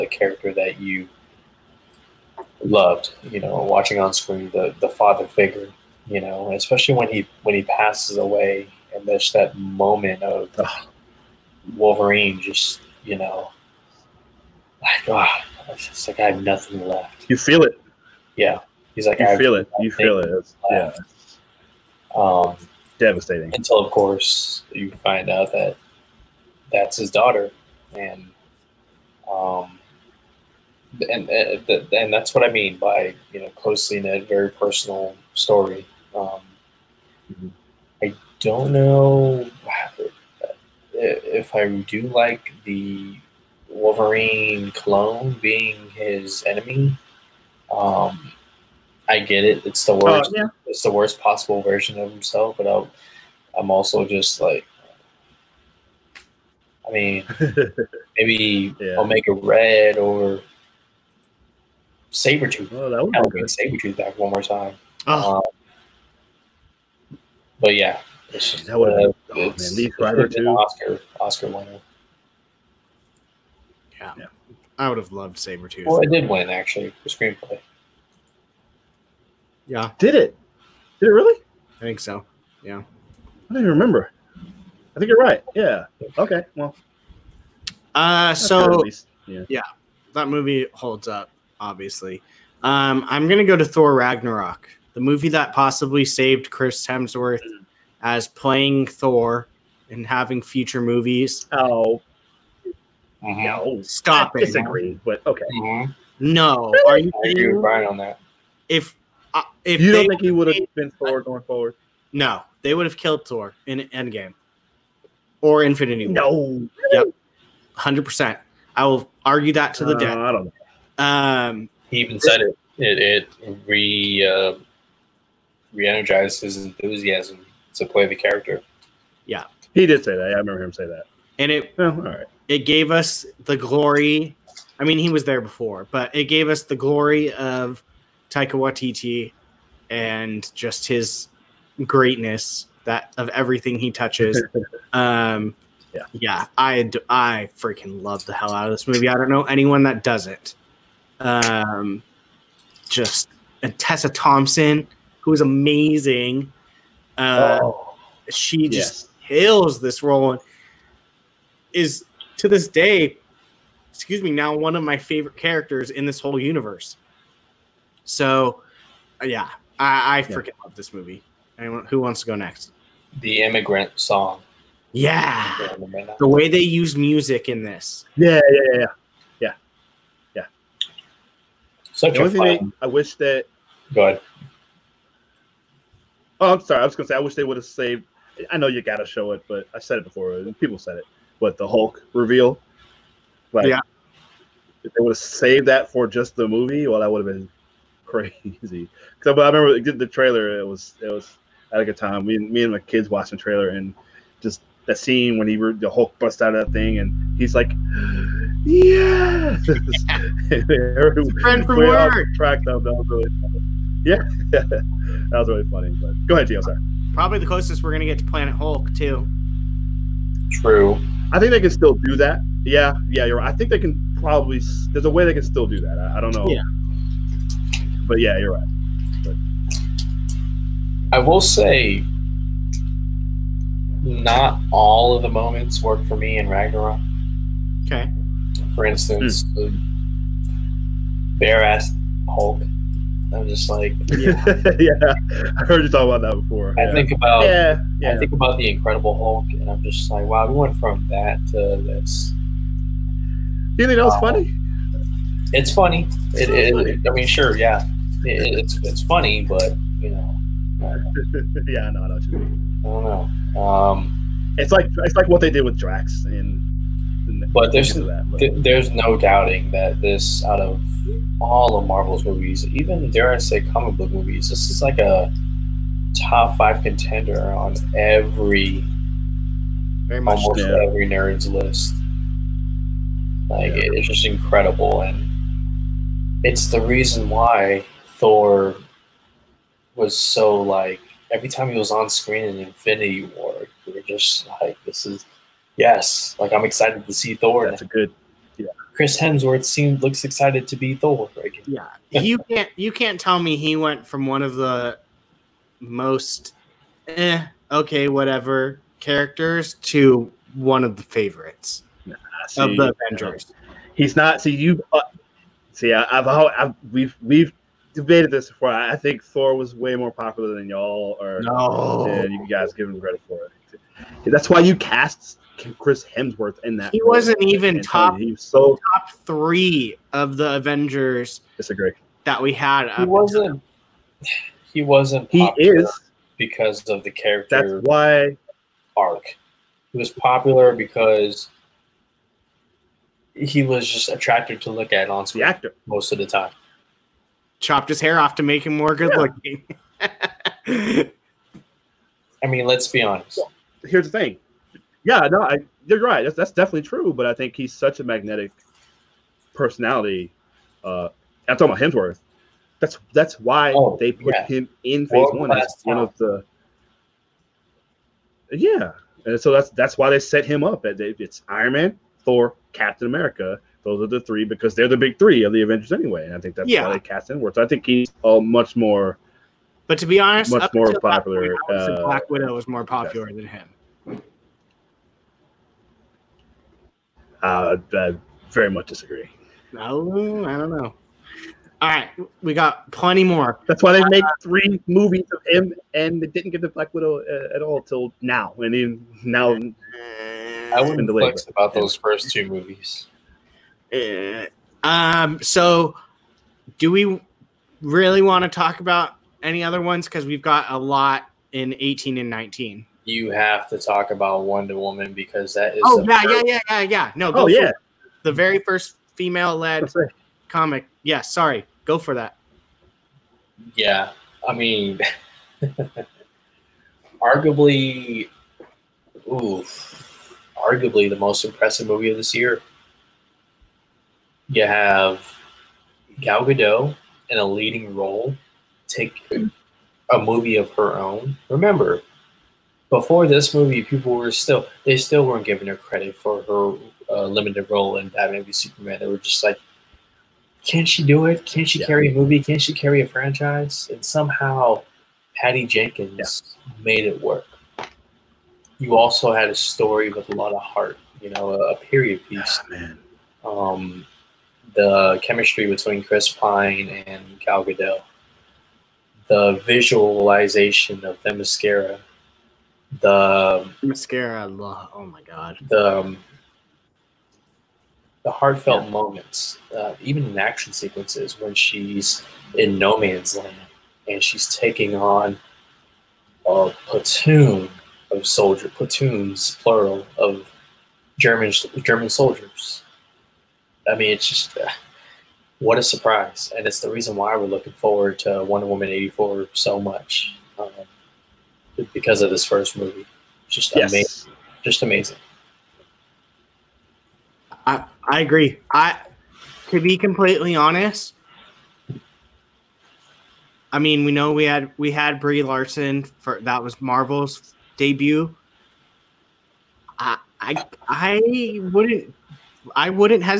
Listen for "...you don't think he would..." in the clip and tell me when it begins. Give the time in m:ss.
1:49.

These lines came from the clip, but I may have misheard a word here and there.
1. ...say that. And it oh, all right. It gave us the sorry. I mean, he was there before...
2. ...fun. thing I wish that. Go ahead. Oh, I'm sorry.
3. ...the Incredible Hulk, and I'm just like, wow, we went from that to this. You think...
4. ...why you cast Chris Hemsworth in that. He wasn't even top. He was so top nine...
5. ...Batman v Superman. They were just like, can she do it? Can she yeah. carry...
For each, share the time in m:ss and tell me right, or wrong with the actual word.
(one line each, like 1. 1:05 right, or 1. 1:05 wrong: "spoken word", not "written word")
1. 2:10 wrong: "glory", not "sorry"
2. 3:02 right
3. 4:08 right
4. 5:24 wrong: "three", not "nine"
5. 7:28 right.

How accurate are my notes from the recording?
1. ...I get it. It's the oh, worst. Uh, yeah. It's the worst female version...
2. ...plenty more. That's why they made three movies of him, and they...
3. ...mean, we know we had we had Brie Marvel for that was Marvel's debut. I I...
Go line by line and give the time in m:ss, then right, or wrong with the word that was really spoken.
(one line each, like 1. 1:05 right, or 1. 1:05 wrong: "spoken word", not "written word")
1. 0:49 wrong: "possible", not "female"
2. 6:32 right
3. 8:33 wrong: "Larson", not "Marvel".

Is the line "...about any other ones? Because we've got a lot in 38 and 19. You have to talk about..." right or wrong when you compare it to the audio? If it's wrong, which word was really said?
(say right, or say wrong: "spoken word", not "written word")
wrong: "18", not "38".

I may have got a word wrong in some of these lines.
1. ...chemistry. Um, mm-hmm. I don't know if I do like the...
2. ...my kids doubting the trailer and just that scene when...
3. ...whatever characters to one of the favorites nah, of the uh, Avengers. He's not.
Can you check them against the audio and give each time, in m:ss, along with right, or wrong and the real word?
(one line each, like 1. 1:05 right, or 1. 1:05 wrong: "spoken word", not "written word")
1. 0:35 wrong: "story", not "chemistry"
2. 3:22 wrong: "watching", not "doubting"
3. 5:08 right.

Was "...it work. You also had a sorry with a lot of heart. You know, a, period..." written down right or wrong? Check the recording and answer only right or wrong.
wrong.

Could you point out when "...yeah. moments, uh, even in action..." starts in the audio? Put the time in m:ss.
7:58.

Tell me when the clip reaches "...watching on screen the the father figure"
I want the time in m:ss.
0:03.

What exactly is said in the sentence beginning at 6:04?
him in Phase World One one of the.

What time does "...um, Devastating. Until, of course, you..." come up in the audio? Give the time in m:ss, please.
0:22.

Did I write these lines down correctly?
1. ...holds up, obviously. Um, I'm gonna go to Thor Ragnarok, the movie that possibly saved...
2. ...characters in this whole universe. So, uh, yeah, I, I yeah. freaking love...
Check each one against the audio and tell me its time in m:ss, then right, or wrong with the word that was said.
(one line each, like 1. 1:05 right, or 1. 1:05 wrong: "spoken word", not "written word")
1. 1:30 right
2. 2:45 right.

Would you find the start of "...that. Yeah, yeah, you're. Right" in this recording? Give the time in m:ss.
3:42.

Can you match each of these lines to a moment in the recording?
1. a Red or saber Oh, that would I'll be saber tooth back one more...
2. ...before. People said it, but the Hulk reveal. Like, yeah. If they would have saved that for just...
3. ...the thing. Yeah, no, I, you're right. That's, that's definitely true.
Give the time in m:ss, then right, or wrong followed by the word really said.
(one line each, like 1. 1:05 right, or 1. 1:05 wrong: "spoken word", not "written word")
1. 0:58 right
2. 3:10 right
3. 5:54 right.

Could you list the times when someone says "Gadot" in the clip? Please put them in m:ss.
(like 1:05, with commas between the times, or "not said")
7:16, 7:47.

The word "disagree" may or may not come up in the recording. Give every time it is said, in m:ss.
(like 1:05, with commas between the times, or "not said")
1:44, 5:31, 6:28.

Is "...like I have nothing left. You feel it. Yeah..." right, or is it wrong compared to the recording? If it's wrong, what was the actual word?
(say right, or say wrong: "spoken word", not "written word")
right.